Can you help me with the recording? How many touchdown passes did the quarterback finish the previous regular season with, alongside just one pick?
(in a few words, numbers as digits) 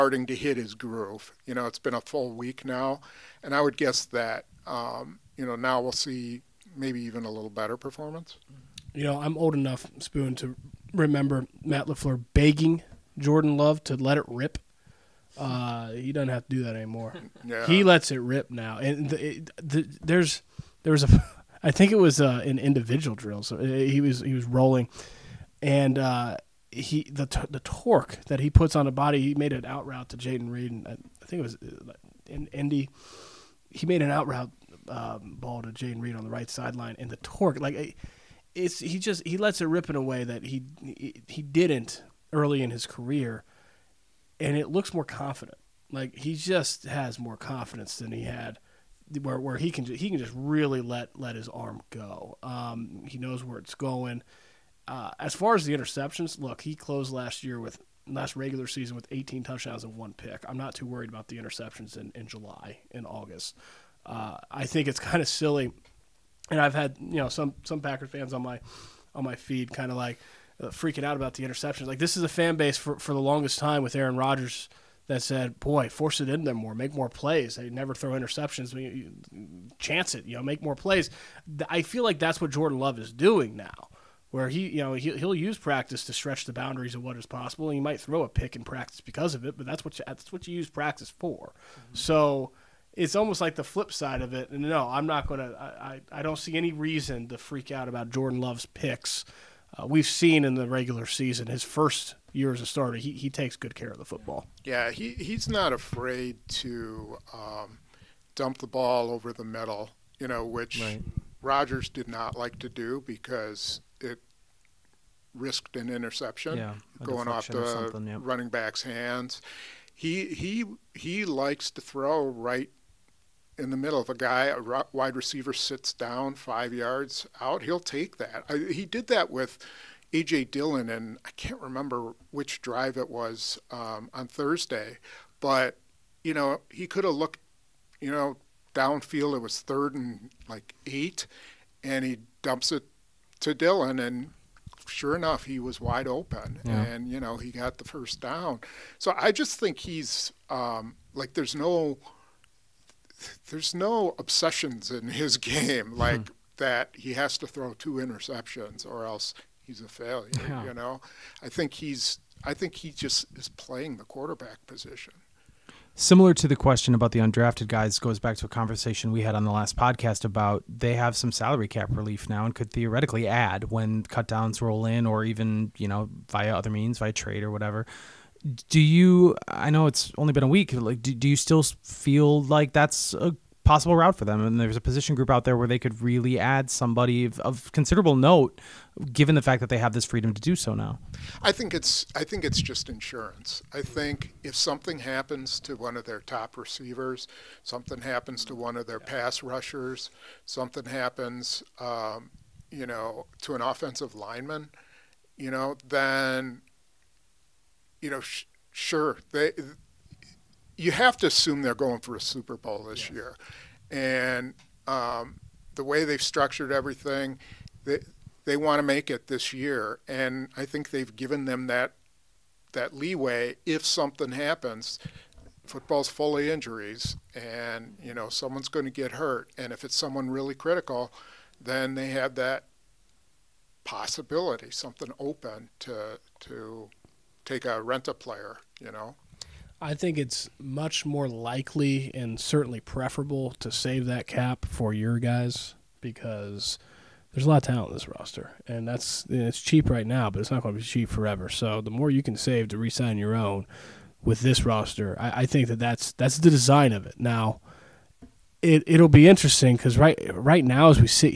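18.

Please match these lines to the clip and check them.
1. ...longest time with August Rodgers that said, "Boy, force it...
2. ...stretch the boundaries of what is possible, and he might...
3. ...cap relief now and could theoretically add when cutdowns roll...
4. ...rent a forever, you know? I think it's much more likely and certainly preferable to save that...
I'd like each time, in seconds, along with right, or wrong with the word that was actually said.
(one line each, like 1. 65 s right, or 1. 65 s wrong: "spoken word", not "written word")
1. 73 s wrong: "Aaron", not "August"
2. 86 s right
3. 171 s right
4. 237 s wrong: "player", not "forever".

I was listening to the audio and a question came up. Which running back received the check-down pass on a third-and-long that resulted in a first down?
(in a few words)
AJ Dillon.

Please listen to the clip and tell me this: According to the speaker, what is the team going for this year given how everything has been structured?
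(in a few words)
Super Bowl.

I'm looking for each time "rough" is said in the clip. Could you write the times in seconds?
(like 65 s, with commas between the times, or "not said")
not said.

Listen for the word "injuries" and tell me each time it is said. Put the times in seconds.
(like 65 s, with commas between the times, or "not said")
226 s.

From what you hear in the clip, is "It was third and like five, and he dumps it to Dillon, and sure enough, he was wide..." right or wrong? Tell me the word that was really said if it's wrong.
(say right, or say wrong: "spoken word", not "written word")
wrong: "eight", not "five".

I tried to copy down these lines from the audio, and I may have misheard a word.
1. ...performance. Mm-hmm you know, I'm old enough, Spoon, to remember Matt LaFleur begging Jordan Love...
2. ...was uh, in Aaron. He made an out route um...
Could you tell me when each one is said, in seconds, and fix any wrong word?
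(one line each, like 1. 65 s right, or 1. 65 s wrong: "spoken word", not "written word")
1. 7 s right
2. 31 s wrong: "Indy", not "Aaron".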